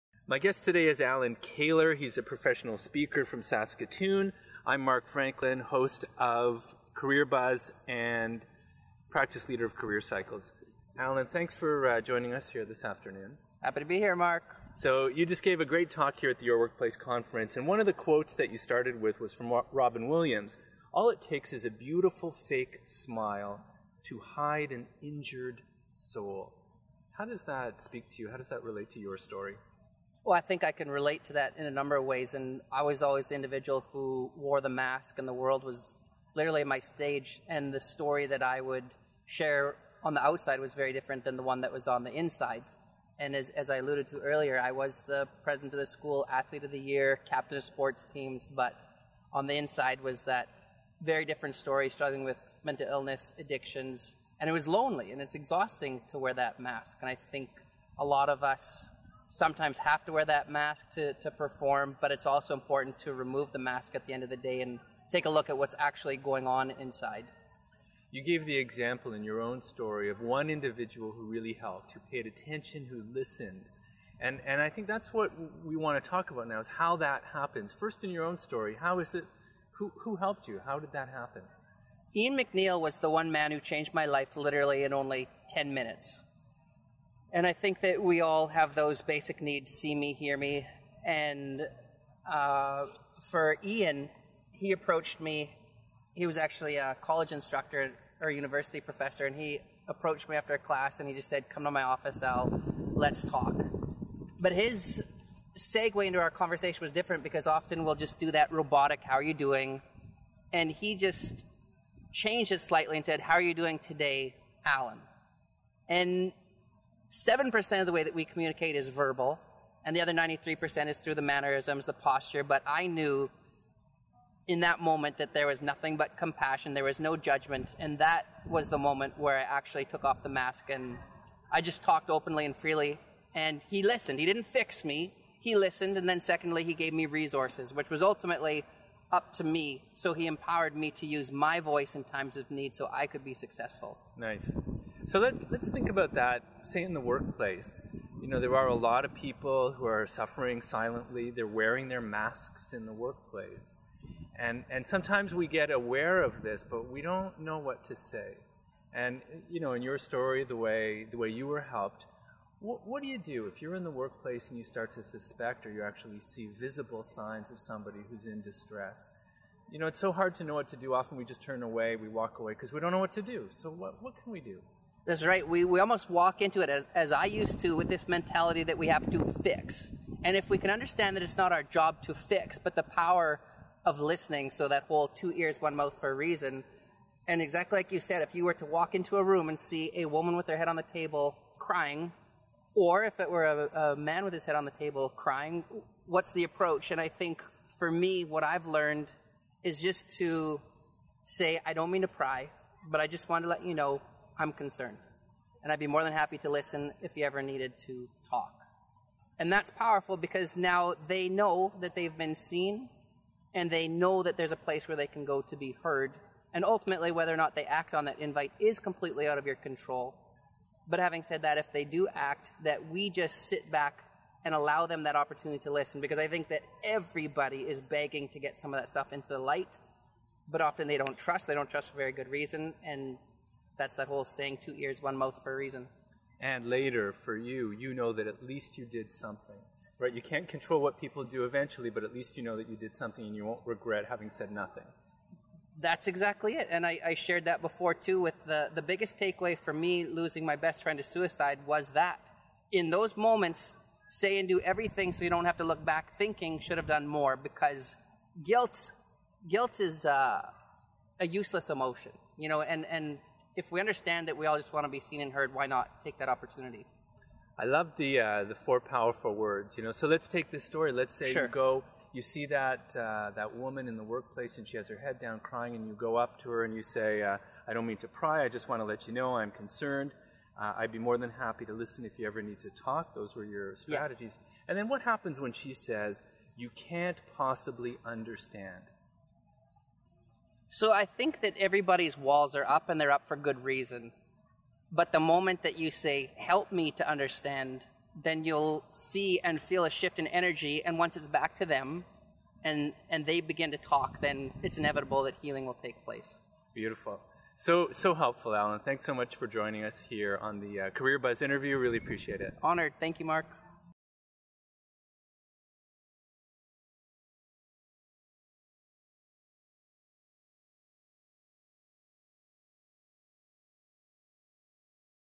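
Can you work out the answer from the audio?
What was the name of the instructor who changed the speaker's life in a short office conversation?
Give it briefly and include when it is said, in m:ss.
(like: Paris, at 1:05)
Ian McNeil, at 1:22.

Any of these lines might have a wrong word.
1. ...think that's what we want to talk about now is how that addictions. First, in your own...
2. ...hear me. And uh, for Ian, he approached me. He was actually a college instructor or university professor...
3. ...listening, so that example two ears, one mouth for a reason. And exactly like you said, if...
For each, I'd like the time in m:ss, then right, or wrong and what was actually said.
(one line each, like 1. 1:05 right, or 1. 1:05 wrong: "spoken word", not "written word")
1. 1:14 wrong: "happens", not "addictions"
2. 1:30 right
3. 3:03 wrong: "whole", not "example".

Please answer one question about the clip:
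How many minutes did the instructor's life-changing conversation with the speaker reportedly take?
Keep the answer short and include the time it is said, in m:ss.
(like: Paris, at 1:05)
10, at 1:25.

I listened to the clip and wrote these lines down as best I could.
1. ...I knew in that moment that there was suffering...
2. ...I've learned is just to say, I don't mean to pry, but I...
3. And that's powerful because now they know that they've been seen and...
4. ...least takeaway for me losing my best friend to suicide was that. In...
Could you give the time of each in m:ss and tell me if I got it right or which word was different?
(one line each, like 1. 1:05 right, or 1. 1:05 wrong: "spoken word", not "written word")
1. 2:02 wrong: "nothing", not "suffering"
2. 3:18 right
3. 3:29 right
4. 4:08 wrong: "biggest", not "least".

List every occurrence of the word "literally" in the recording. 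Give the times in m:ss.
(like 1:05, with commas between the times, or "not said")
0:36, 1:24.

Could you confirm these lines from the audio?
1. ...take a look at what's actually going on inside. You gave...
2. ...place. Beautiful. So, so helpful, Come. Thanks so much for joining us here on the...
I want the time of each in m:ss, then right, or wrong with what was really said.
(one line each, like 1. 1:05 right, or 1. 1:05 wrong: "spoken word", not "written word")
1. 1:05 right
2. 5:06 wrong: "Allan", not "Come".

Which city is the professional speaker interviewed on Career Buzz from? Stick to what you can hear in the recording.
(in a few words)
Saskatoon.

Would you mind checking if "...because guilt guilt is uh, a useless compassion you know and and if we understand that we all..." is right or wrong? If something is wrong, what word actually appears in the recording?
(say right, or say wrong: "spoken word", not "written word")
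wrong: "emotion", not "compassion".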